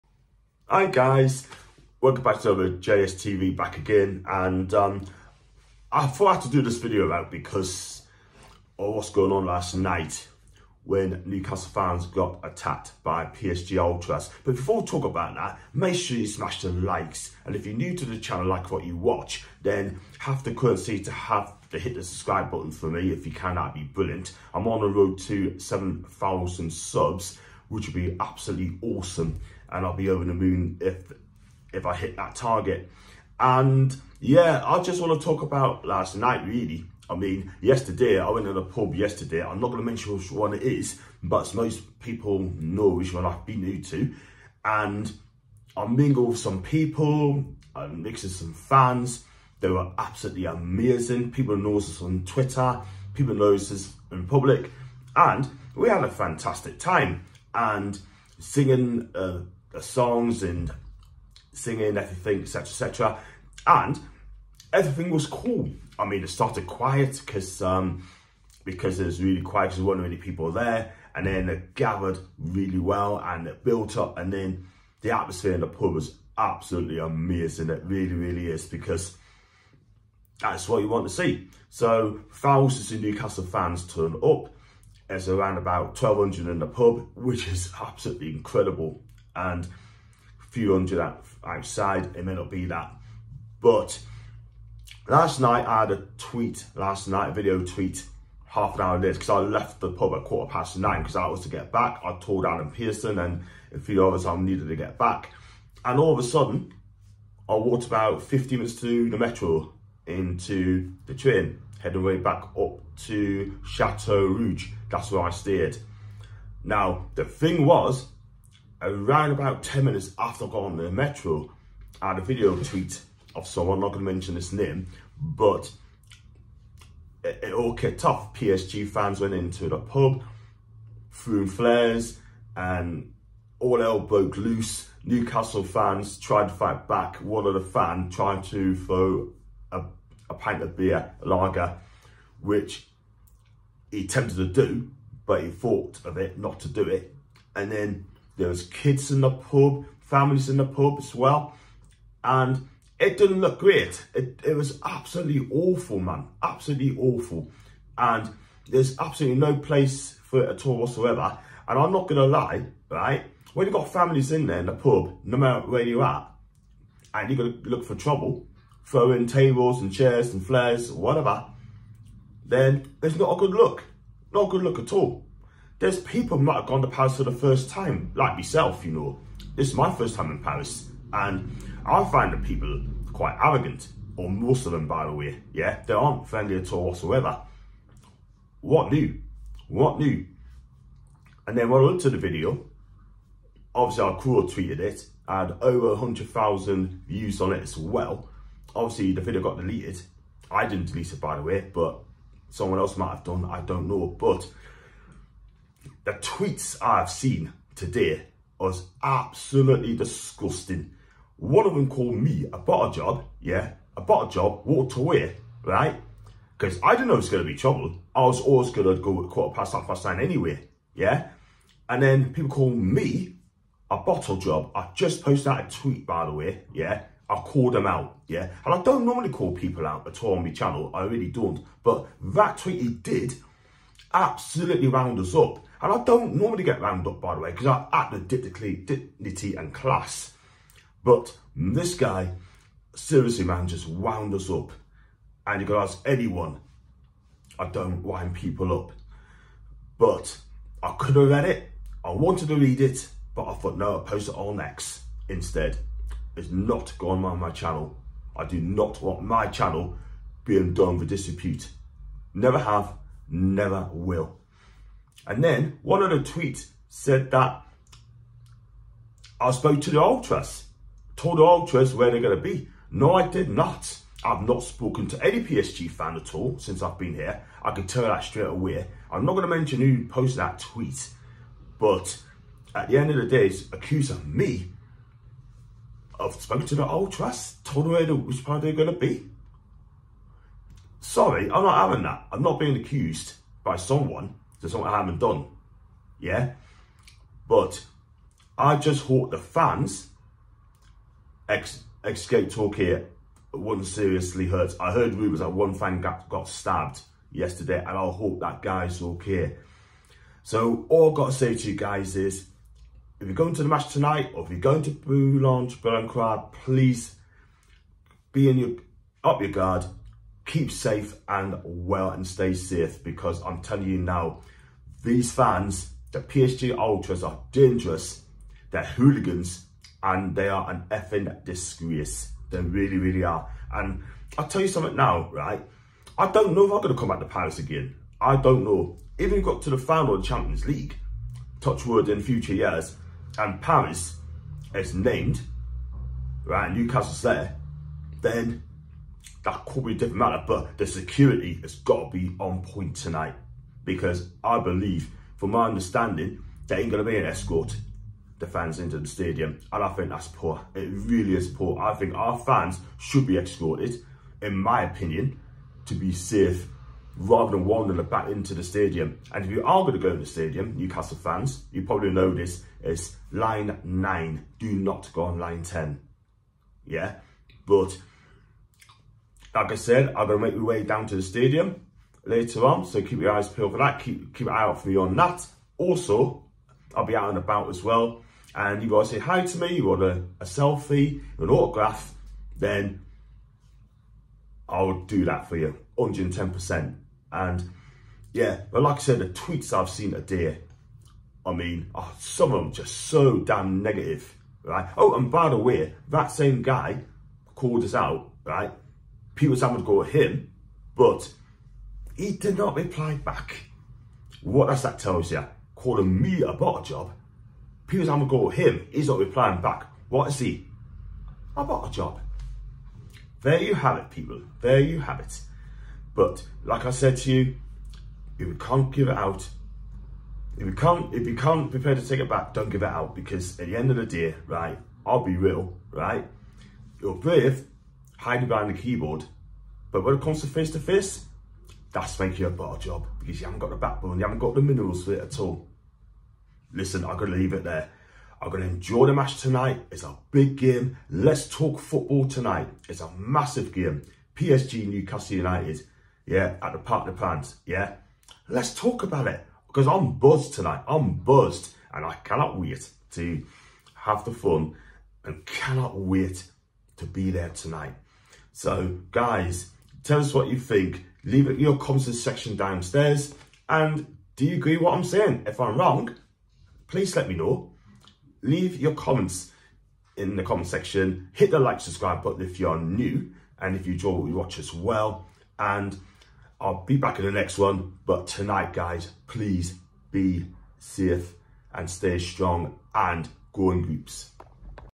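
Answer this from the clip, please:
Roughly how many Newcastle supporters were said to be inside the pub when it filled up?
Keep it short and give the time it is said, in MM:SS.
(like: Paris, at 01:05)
1,200, at 01:26.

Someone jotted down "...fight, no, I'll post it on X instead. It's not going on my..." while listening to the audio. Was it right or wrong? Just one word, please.
wrong.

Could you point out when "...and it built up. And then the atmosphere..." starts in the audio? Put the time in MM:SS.
01:13.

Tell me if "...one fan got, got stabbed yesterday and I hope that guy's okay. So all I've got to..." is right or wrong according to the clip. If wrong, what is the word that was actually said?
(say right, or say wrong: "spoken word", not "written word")
right.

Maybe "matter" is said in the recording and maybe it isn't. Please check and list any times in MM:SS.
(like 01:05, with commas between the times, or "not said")
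02:45, 05:50.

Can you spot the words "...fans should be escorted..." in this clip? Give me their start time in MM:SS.
06:02.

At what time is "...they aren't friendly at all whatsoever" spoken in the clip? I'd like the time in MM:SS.
03:05.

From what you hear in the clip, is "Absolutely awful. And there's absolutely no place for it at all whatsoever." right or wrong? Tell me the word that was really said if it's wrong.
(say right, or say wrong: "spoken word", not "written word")
right.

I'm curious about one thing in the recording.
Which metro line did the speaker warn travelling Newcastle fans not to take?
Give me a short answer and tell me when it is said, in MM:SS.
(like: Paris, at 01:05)
line 10, at 06:15.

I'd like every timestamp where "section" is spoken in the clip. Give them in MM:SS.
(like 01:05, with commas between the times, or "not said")
07:52, 08:00.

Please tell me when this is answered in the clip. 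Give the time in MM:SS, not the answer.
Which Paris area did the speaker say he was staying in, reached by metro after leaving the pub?
01:53.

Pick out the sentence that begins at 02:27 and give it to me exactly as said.
And then there was kids in the pub, families in the pub as well.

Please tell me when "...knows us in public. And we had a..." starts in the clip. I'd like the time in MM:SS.
00:53.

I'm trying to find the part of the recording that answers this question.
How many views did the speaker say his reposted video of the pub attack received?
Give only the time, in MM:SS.
03:15.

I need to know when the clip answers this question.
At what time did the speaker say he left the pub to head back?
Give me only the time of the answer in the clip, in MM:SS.
01:40.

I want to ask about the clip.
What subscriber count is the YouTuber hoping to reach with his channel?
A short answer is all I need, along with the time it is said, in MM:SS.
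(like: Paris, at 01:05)
7,000, at 00:25.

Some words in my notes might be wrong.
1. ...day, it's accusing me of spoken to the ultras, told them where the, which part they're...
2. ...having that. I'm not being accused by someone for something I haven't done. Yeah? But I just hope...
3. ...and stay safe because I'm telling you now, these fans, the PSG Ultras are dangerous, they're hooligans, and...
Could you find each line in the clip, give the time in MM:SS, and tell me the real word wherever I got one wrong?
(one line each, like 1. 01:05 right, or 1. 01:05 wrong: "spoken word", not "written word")
1. 04:43 right
2. 04:51 right
3. 05:22 right.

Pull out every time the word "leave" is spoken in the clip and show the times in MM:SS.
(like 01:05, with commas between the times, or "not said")
07:27, 07:51, 07:58.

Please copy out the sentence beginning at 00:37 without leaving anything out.
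I mean, yesterday, I went to the pub yesterday.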